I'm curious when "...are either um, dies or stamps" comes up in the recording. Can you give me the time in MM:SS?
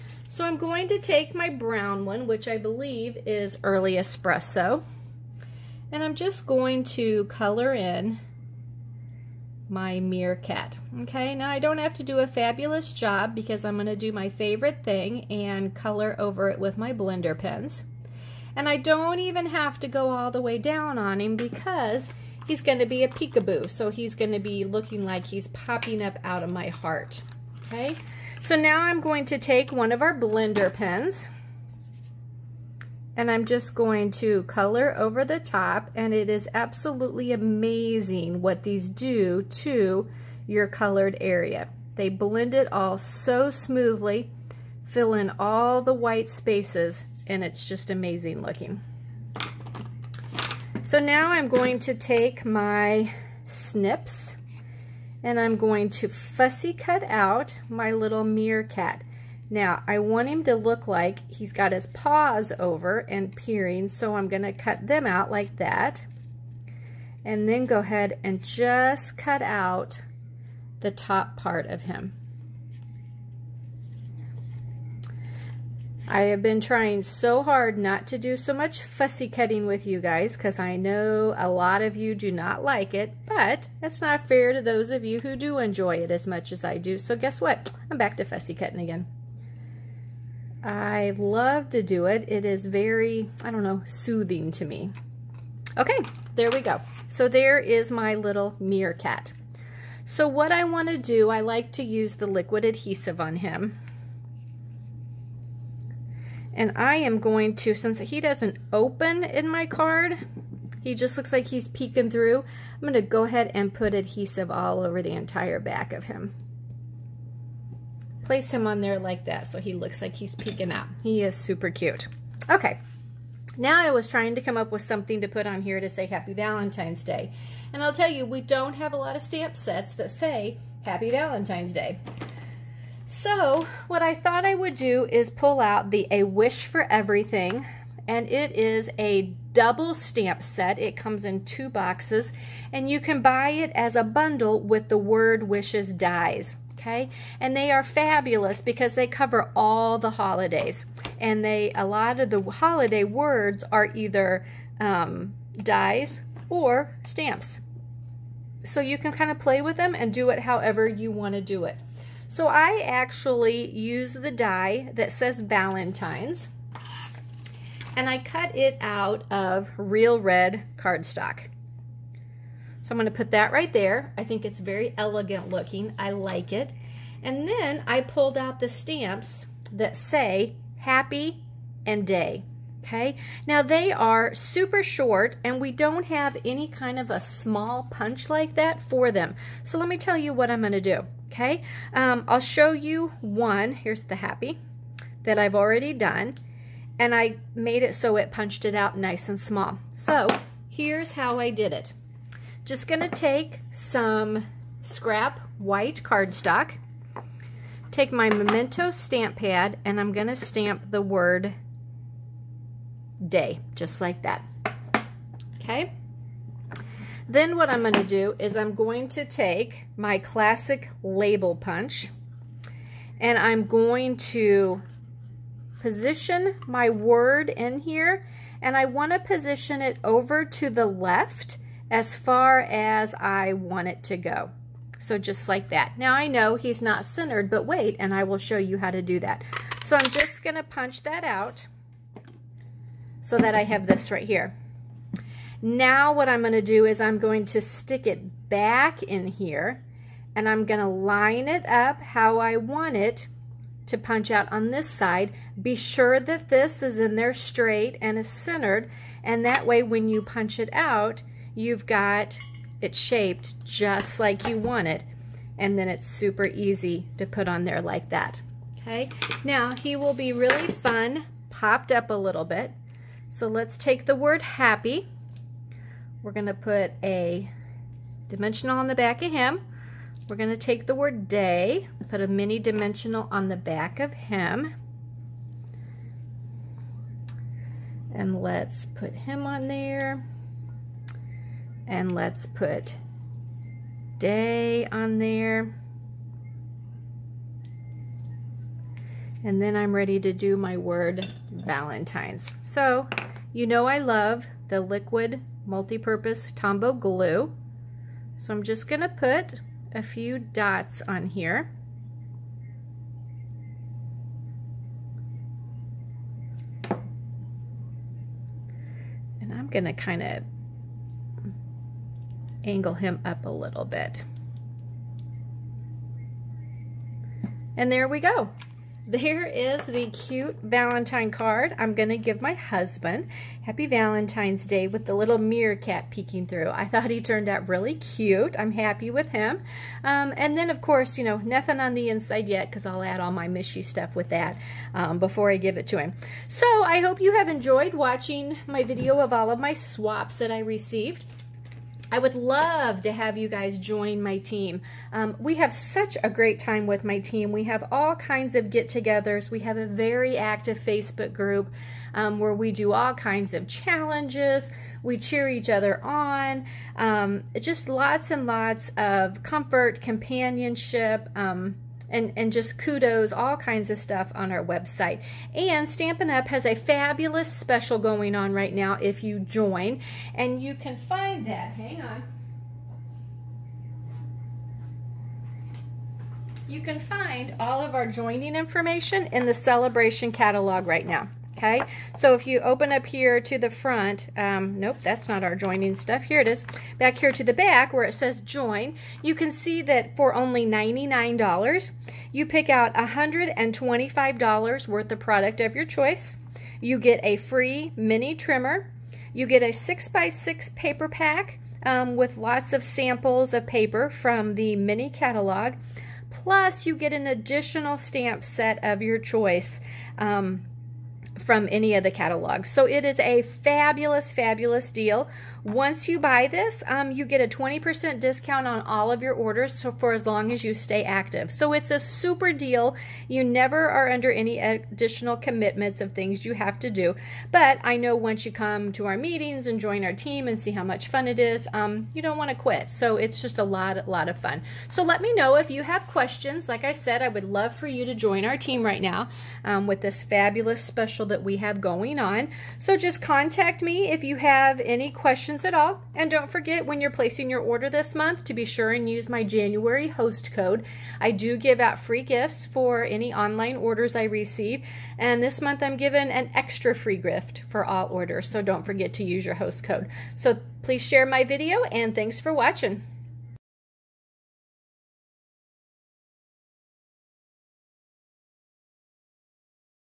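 02:33.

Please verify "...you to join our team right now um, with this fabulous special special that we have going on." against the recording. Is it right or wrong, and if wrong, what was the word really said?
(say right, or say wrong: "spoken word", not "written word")
right.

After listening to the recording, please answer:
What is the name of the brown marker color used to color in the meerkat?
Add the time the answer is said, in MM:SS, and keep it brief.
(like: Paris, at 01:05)
Early Espresso, at 00:03.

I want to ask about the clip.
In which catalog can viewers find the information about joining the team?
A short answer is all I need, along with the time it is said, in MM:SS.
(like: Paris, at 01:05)
Celebration Catalog, at 06:29.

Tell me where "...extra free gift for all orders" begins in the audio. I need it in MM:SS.
07:46.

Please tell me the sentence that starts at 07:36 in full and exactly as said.
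And don't forget when you're placing your order this month to be sure and use my January host code.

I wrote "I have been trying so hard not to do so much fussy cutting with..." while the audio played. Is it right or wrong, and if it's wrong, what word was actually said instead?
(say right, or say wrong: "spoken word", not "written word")
right.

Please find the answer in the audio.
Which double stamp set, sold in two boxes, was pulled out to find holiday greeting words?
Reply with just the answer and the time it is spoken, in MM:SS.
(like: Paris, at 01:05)
A Wish for Everything, at 02:16.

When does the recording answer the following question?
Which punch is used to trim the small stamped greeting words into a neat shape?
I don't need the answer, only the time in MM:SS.
03:40.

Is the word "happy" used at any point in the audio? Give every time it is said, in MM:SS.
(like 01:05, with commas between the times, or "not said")
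02:06, 02:10, 03:00, 03:14, 04:34, 05:33, 05:38.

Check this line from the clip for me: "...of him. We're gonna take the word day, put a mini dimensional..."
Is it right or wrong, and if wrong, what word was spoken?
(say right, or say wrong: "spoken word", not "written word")
right.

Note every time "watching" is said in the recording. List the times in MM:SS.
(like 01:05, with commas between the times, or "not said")
05:47, 07:52.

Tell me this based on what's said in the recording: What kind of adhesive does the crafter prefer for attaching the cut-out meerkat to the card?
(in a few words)
liquid adhesive.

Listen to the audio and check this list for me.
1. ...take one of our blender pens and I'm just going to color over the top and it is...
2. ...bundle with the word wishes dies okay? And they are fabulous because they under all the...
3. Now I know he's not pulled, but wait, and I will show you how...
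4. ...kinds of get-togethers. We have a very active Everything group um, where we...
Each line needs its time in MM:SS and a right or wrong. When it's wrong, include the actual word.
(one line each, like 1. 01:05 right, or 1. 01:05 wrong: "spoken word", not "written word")
1. 00:29 right
2. 02:24 wrong: "cover", not "under"
3. 03:55 wrong: "centered", not "pulled"
4. 05:58 wrong: "Facebook", not "Everything".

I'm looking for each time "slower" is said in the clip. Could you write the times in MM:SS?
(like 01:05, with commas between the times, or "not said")
not said.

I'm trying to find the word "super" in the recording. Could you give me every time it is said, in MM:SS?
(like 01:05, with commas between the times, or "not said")
02:01, 03:04, 04:26, 07:11.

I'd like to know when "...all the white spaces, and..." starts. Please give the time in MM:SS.
00:45.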